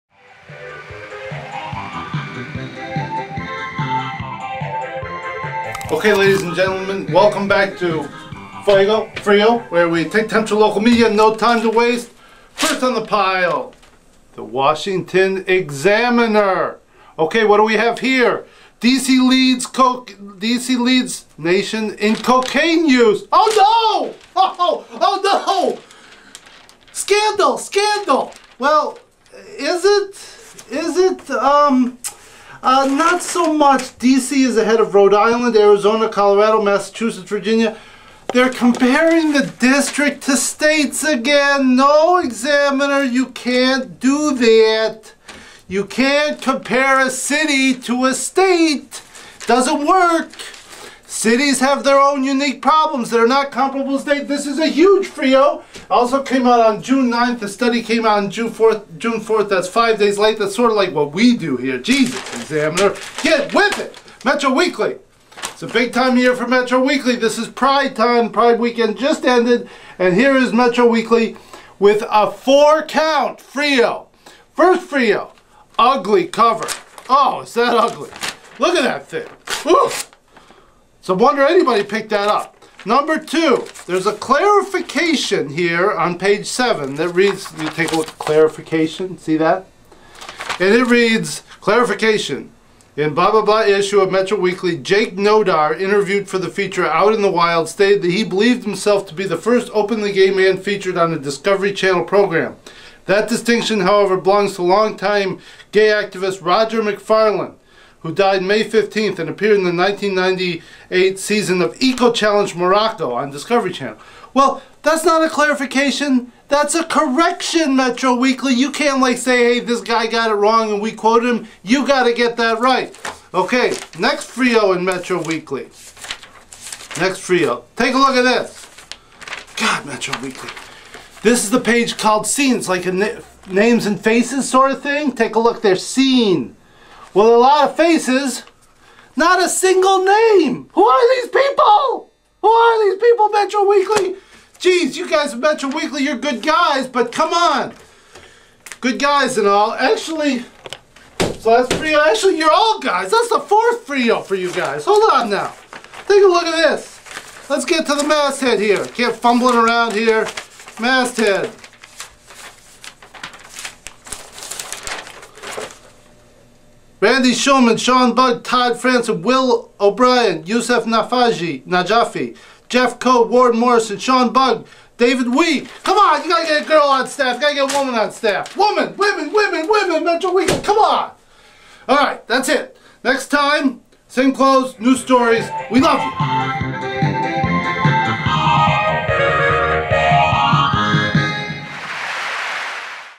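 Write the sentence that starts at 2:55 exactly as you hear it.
Come on, you gotta get a girl on staff.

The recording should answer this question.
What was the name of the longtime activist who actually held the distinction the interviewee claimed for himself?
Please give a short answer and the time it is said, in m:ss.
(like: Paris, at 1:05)
Roger McFarlane, at 1:46.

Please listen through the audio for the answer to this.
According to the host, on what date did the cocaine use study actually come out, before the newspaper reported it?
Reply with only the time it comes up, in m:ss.
0:58.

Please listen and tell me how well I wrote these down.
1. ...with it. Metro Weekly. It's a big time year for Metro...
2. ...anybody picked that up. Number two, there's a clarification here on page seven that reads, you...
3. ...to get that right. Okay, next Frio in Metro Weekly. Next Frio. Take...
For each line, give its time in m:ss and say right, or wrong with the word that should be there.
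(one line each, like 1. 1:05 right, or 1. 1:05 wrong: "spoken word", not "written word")
1. 1:03 right
2. 1:21 right
3. 2:02 right.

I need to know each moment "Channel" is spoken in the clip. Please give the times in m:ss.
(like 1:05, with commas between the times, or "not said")
1:41, 1:53.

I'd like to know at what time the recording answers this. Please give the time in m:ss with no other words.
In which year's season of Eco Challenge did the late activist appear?
1:49.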